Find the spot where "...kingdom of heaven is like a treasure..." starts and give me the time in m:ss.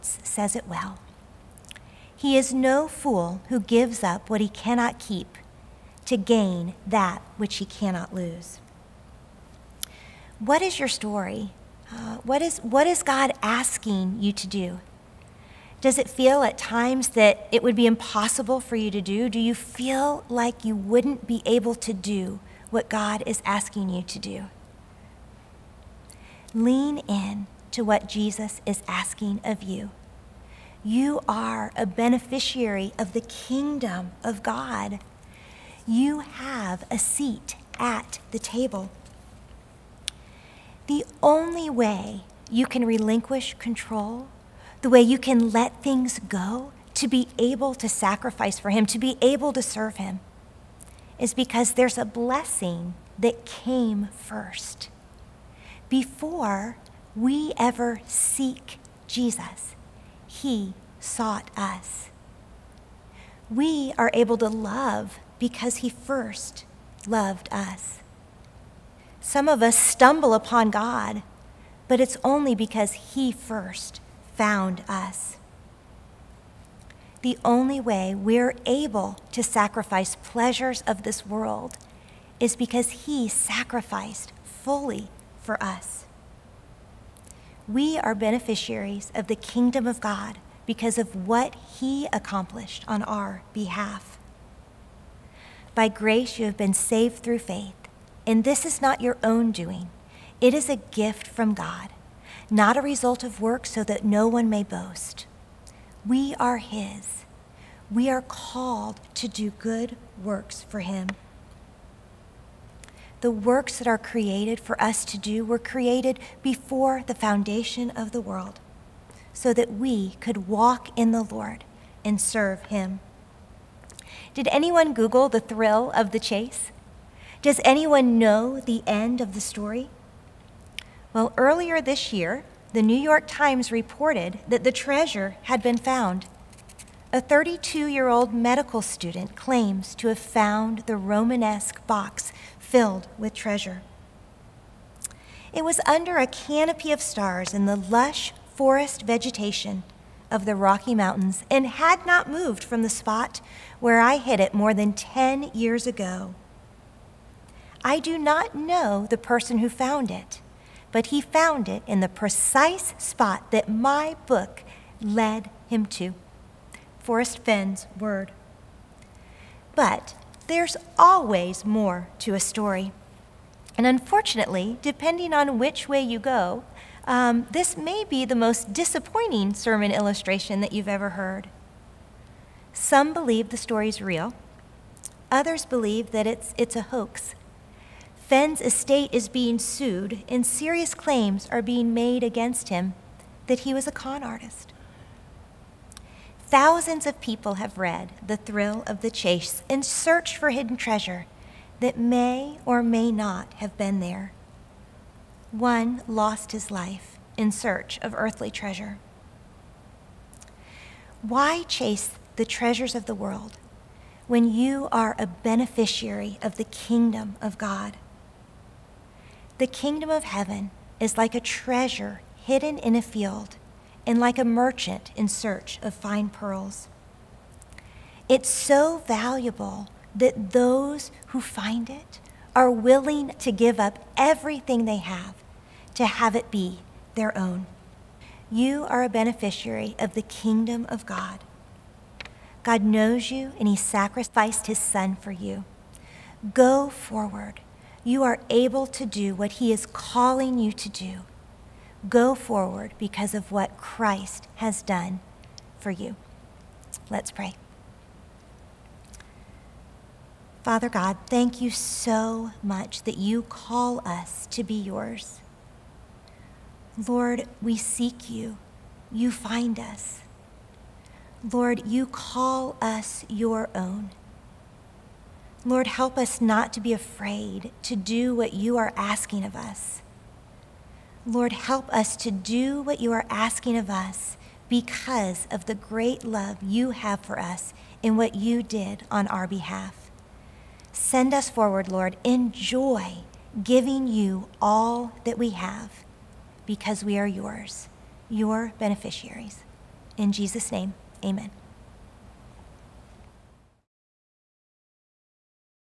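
3:39.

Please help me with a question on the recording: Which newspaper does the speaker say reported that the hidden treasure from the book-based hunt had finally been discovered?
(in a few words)
New York Times.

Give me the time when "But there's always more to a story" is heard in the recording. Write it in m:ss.
2:49.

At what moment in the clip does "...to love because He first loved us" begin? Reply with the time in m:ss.
1:04.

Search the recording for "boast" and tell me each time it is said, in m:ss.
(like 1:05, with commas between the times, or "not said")
1:44.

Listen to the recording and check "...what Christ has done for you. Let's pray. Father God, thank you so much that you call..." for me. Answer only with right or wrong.
right.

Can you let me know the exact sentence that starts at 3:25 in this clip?
One lost his life in search of earthly treasure.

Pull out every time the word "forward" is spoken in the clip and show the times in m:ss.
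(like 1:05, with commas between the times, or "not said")
4:06, 4:12, 4:51.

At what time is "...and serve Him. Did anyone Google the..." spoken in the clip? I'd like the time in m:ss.
2:02.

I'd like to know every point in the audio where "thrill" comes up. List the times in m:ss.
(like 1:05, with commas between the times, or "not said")
2:05, 3:18.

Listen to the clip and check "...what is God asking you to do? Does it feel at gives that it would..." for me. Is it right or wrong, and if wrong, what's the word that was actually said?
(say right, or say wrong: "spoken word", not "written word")
wrong: "times", not "gives".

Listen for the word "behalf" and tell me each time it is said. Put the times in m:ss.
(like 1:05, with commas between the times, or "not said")
1:33, 4:49.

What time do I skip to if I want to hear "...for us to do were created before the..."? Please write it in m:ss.
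1:54.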